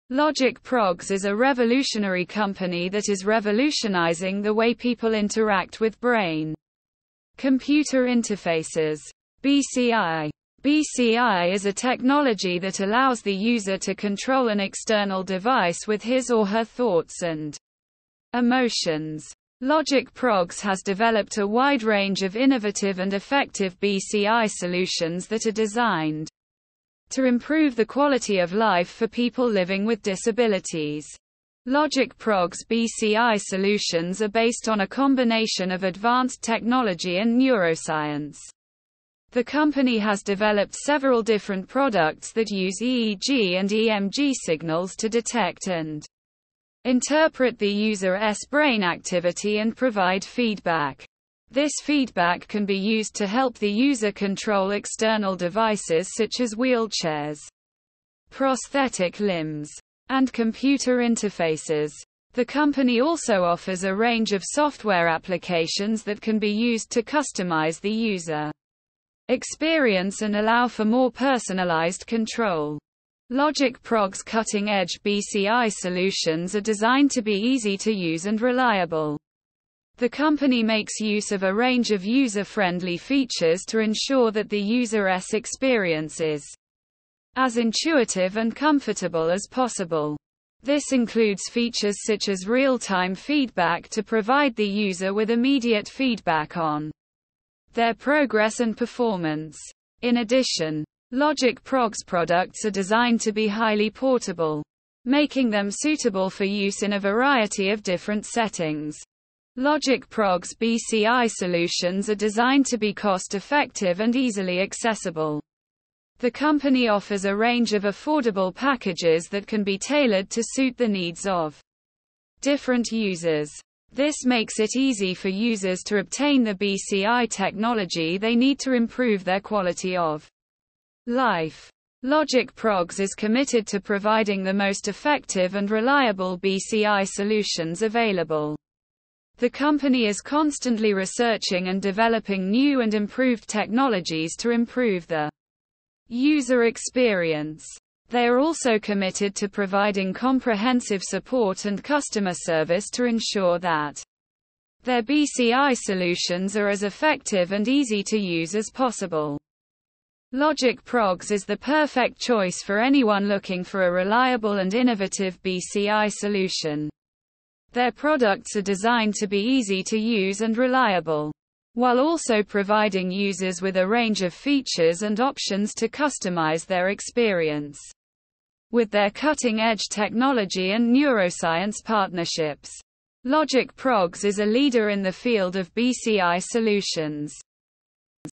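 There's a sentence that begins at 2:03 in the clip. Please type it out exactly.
This makes it easy for users to obtain the BCI technology they need to improve their quality of life.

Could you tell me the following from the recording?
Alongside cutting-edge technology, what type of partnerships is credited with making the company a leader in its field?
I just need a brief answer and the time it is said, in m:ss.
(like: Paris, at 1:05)
neuroscience partnerships, at 3:00.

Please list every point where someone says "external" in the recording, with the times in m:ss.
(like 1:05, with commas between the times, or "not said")
0:14, 0:54.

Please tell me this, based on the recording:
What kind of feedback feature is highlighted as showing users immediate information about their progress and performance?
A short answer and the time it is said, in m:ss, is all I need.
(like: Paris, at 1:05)
real-time feedback, at 1:32.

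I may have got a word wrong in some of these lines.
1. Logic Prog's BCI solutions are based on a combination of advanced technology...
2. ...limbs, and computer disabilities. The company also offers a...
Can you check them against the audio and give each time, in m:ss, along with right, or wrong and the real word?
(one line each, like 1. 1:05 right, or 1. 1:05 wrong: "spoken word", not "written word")
1. 0:31 right
2. 0:59 wrong: "interfaces", not "disabilities".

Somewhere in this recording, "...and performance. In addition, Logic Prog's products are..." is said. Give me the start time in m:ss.
1:38.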